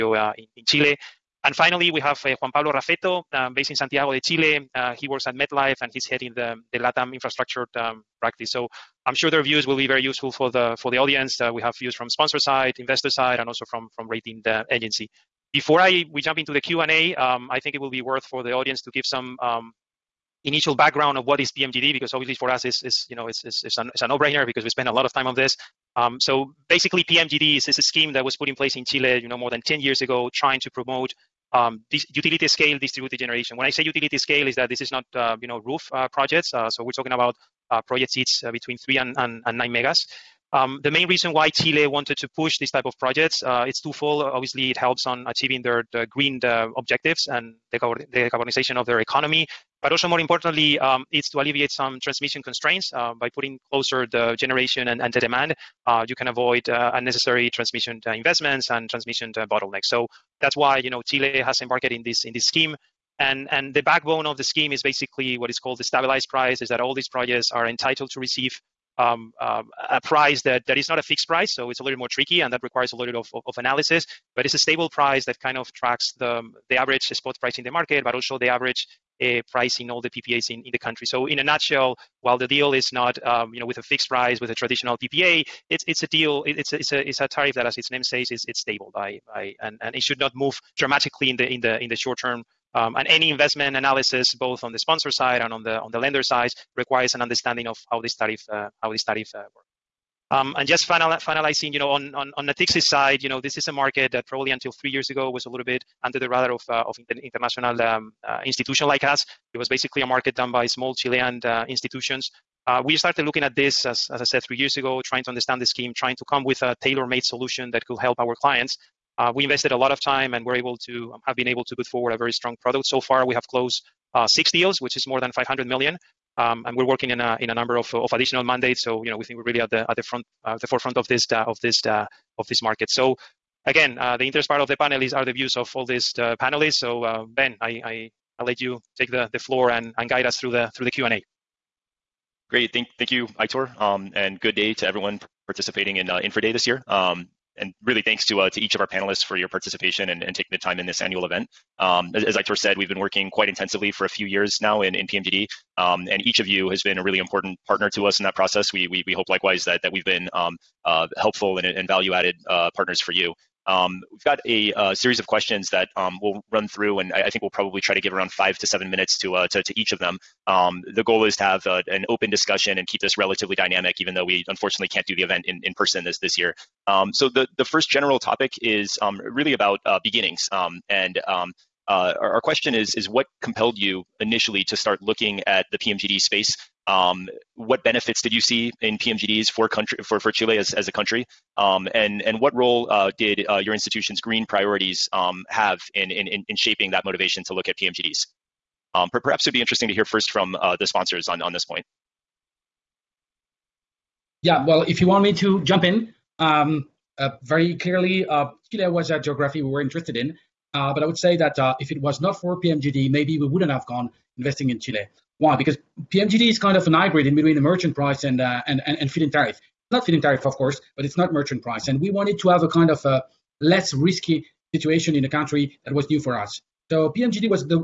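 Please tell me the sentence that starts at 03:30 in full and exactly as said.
Uh, but I would say that if it was not for PMGD, maybe we wouldn't have gone investing in Chile.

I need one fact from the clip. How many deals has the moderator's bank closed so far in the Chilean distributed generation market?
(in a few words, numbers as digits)
6.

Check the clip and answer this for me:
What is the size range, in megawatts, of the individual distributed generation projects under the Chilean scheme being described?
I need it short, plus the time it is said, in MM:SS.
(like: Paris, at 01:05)
3 to 9, at 00:38.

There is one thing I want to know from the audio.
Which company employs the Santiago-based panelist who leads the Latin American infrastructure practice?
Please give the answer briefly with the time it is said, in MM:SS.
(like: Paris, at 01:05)
MetLife, at 00:05.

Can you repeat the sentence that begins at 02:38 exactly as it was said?
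We we, we hope likewise that that we've been um, uh, helpful and, and value added uh, partners for you.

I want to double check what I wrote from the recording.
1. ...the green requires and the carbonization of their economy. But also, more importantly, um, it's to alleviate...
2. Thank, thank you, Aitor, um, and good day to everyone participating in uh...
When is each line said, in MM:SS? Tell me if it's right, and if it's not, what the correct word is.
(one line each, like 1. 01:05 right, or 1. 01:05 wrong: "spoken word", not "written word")
1. 00:45 wrong: "objectives", not "requires"
2. 02:22 right.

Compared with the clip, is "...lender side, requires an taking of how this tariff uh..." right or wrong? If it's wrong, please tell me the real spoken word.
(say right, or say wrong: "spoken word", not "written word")
wrong: "understanding", not "taking".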